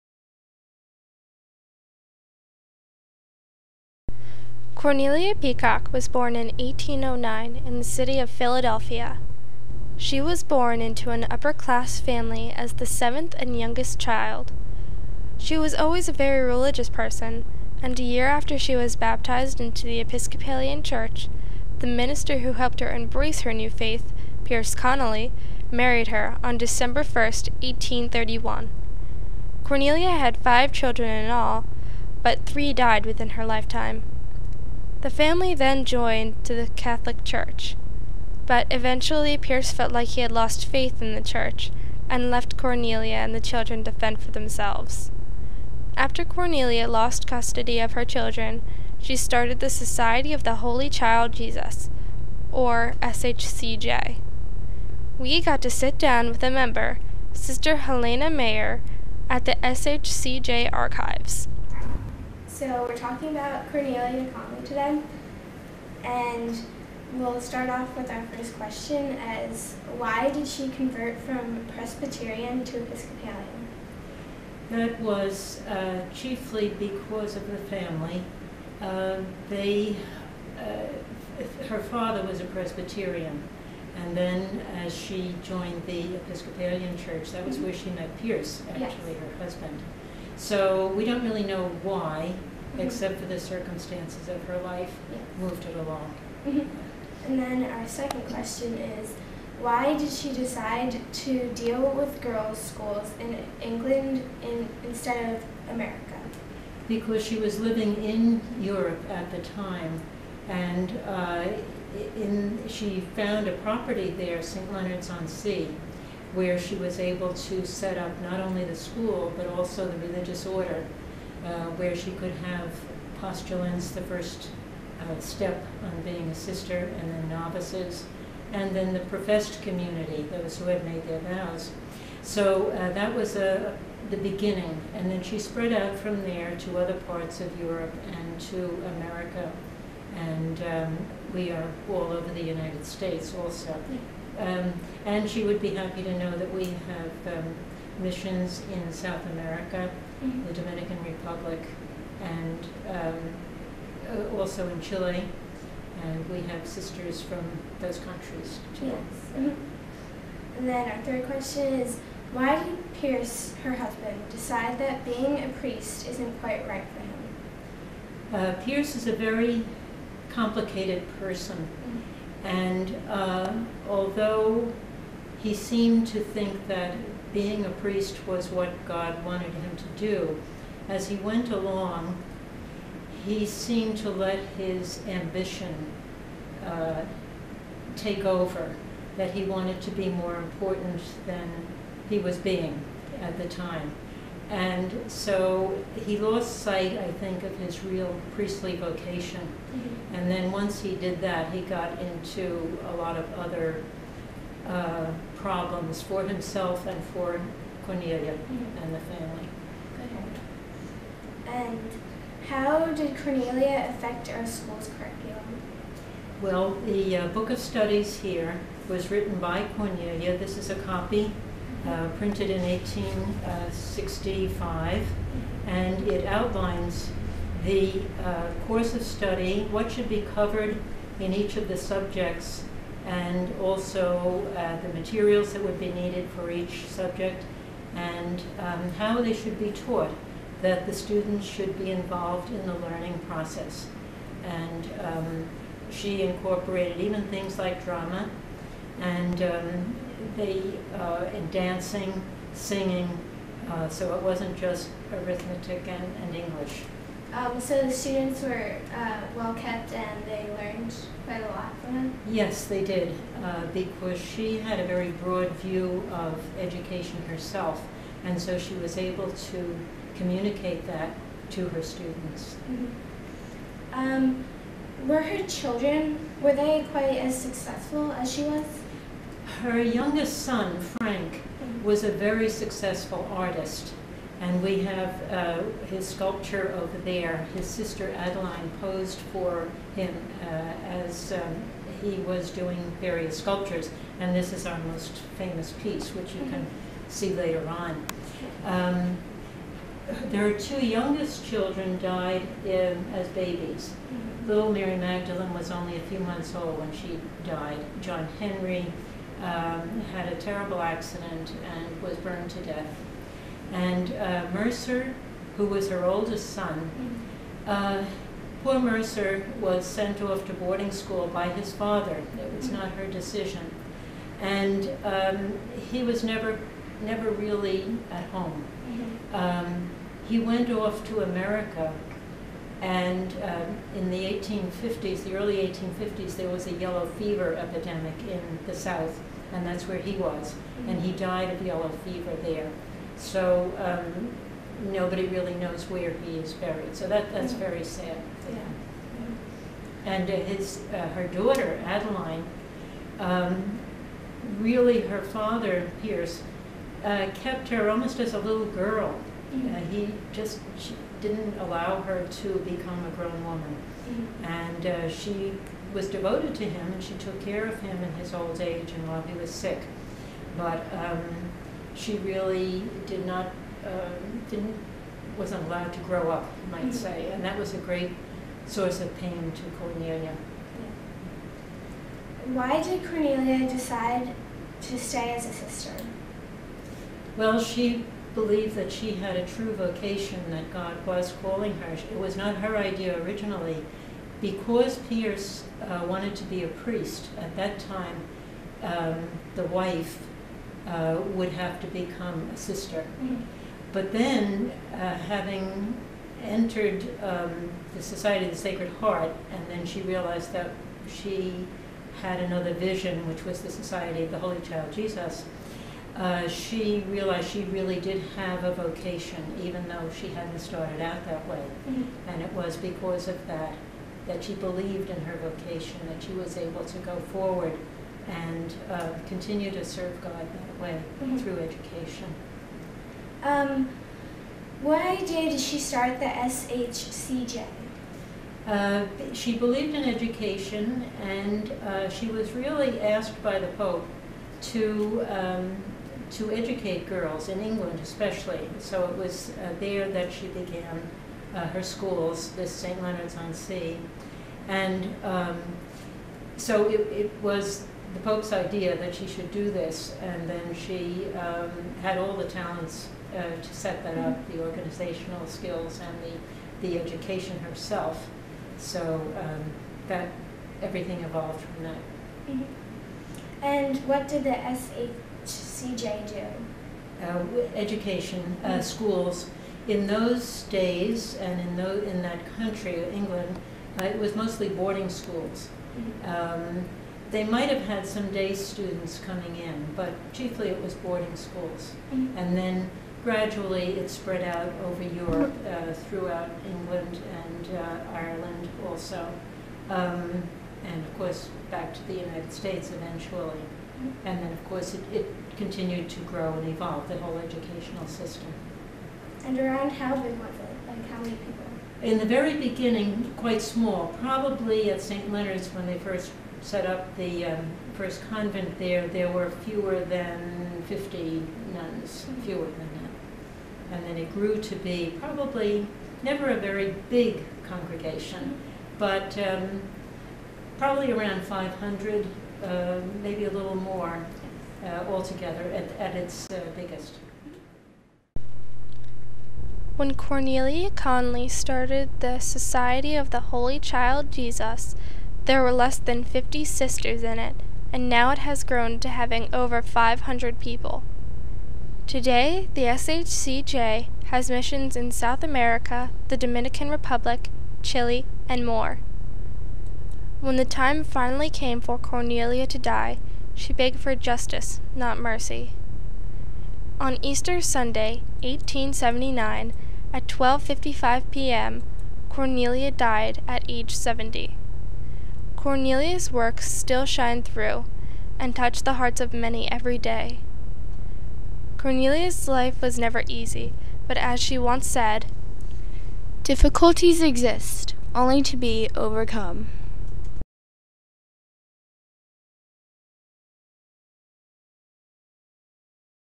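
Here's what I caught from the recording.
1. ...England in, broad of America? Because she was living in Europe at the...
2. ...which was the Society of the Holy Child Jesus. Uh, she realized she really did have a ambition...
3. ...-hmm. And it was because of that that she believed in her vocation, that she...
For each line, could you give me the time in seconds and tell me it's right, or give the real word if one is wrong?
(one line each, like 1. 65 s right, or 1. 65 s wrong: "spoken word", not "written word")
1. 103 s wrong: "instead", not "broad"
2. 413 s wrong: "vocation", not "ambition"
3. 421 s right.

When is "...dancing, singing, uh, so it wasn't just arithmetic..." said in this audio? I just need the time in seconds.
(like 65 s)
251 s.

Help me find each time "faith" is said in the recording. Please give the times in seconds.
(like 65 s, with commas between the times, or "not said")
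23 s, 40 s.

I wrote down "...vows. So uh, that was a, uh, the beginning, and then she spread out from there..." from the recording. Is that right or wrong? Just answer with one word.
right.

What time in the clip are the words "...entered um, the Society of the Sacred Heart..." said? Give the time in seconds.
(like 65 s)
406 s.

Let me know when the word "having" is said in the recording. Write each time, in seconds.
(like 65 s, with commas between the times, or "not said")
405 s, 549 s.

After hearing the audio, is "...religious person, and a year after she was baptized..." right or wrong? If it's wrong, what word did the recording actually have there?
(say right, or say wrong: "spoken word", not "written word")
right.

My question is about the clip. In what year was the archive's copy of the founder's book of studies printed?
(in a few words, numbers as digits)
1865.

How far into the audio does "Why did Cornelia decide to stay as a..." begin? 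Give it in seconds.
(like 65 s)
382 s.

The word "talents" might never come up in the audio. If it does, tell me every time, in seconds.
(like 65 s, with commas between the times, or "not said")
462 s.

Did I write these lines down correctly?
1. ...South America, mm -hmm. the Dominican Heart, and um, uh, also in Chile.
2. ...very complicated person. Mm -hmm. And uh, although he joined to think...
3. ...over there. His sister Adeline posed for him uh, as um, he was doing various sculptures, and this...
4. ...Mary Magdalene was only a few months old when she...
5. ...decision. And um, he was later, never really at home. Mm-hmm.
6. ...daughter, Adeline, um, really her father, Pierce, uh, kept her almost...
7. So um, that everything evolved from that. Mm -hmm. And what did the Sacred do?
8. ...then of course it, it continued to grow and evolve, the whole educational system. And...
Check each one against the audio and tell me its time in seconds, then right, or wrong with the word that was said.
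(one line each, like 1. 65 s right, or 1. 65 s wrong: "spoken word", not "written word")
1. 148 s wrong: "Republic", not "Heart"
2. 169 s wrong: "seemed", not "joined"
3. 286 s right
4. 304 s right
5. 323 s wrong: "never", not "later"
6. 351 s right
7. 468 s wrong: "SHCJ", not "Sacred"
8. 504 s right.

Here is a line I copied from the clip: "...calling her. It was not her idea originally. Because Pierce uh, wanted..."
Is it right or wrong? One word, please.
right.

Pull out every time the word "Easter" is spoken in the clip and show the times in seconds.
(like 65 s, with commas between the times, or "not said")
567 s.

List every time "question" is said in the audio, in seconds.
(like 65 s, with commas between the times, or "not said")
68 s, 98 s, 161 s.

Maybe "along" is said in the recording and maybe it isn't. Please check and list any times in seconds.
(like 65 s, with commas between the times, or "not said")
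95 s, 181 s.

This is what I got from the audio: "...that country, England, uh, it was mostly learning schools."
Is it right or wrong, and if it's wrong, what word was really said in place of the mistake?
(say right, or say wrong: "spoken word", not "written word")
wrong: "boarding", not "learning".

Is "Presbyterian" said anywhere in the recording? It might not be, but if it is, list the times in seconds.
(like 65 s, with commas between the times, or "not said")
71 s, 82 s.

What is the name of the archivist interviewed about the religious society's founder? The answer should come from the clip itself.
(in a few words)
Helena Mayer.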